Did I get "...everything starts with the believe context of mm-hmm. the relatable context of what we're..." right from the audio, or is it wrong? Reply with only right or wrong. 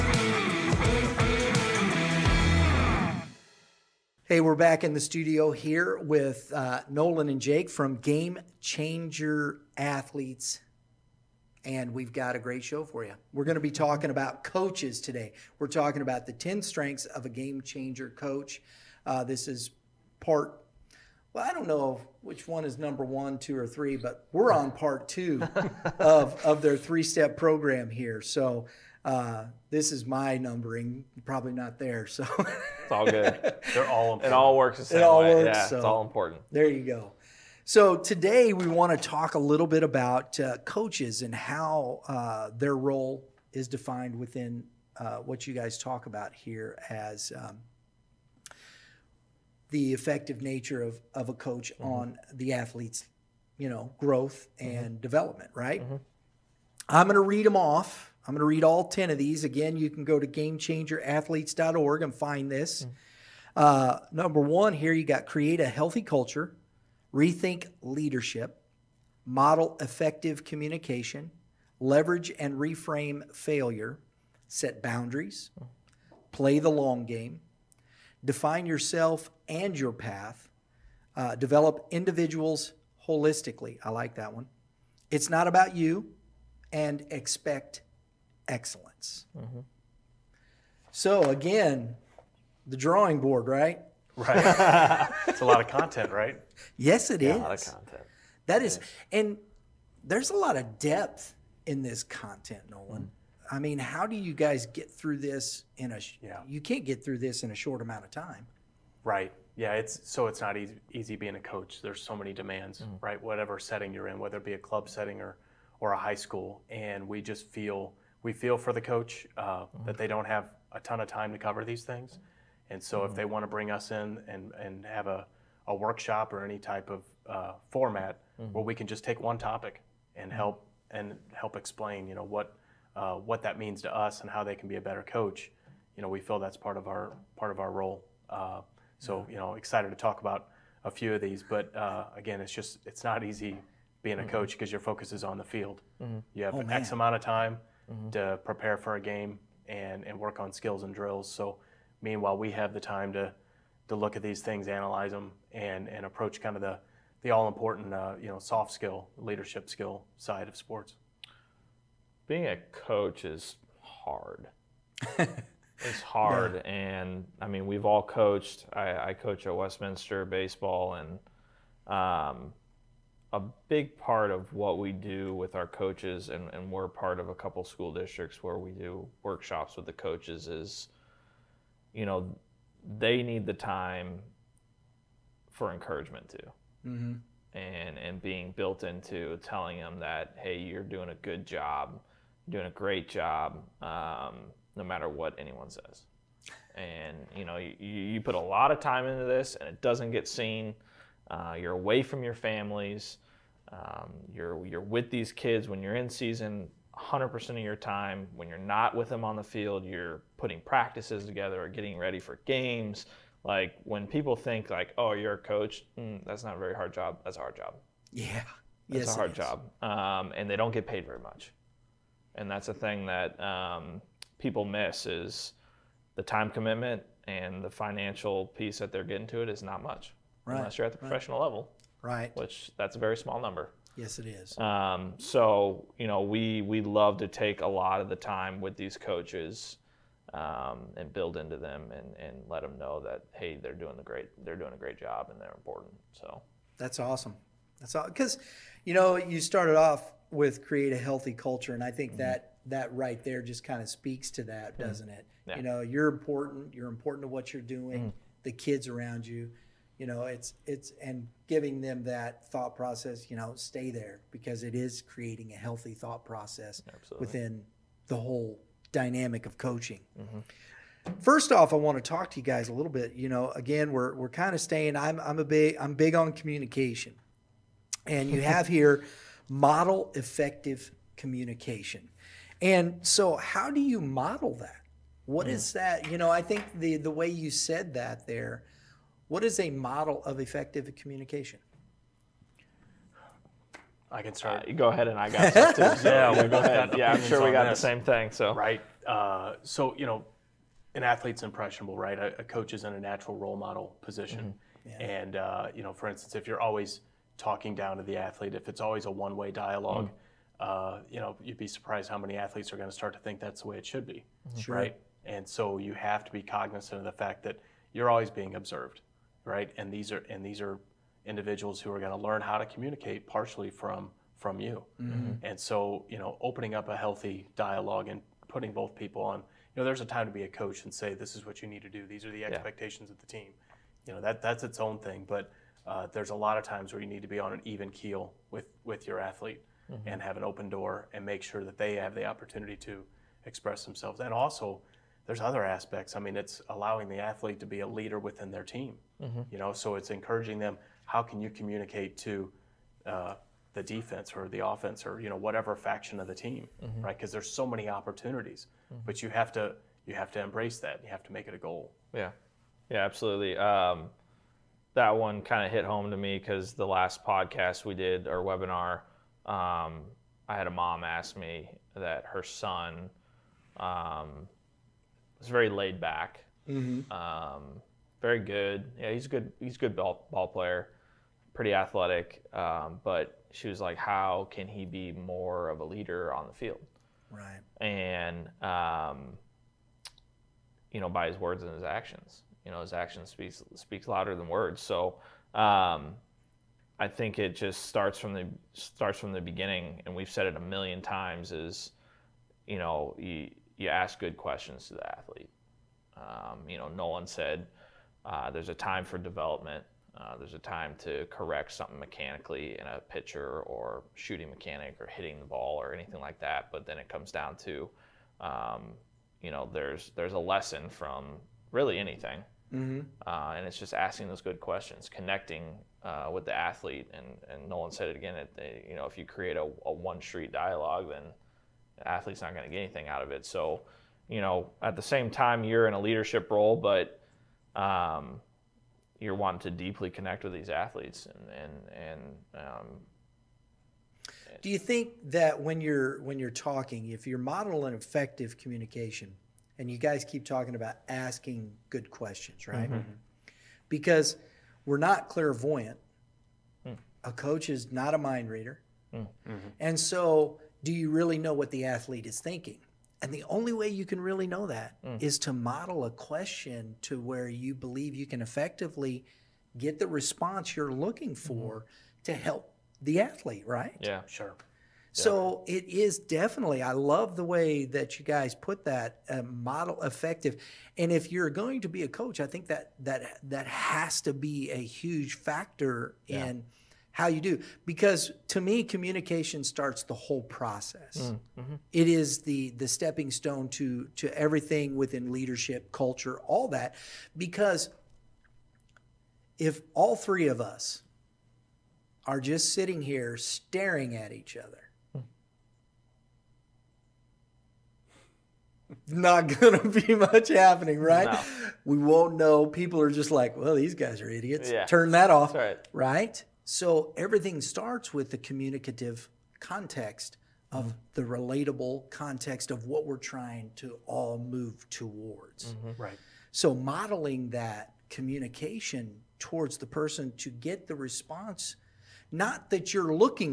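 wrong.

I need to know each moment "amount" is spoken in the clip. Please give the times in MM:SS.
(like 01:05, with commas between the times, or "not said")
01:47, 02:26.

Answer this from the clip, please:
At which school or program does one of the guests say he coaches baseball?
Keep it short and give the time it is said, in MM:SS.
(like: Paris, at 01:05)
Westminster, at 02:49.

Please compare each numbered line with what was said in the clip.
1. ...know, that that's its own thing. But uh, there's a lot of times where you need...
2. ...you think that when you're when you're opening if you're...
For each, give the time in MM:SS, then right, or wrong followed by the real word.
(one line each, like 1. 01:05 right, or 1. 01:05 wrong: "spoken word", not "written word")
1. 05:34 right
2. 07:24 wrong: "talking", not "opening".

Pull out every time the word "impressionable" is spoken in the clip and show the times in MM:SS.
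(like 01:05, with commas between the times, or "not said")
05:01.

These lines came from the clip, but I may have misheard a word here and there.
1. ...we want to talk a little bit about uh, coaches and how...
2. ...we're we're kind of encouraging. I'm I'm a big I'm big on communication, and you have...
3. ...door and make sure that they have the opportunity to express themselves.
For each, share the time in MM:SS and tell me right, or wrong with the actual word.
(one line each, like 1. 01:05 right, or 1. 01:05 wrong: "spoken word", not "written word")
1. 00:38 right
2. 04:33 wrong: "staying", not "encouraging"
3. 05:40 right.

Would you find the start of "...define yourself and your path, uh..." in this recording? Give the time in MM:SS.
01:18.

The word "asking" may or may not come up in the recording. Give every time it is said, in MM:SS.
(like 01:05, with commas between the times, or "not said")
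07:03, 07:31.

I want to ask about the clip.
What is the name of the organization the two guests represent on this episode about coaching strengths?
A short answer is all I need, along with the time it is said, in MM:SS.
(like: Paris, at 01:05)
Game Changer Athletes, at 00:07.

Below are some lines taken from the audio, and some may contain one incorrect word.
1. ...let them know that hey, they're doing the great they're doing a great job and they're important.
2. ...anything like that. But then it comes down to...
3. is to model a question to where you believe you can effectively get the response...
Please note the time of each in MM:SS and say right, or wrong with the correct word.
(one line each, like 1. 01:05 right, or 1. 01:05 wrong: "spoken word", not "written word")
1. 04:02 right
2. 06:55 right
3. 07:45 right.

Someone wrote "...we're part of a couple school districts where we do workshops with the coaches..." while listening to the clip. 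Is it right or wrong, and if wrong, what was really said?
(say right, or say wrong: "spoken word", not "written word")
right.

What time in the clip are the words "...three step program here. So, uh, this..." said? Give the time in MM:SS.
00:26.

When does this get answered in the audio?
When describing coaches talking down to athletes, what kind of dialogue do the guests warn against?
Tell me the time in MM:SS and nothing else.
05:09.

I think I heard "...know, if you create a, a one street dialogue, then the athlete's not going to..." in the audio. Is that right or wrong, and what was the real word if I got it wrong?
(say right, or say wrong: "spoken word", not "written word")
right.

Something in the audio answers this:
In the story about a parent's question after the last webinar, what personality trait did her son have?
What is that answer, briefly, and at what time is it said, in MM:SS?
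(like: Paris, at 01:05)
laid back, at 06:15.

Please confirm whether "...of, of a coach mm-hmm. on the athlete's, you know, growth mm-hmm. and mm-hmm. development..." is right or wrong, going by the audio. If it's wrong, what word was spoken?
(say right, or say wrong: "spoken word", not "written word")
right.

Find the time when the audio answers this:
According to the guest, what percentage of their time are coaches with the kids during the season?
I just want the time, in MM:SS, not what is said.
03:26.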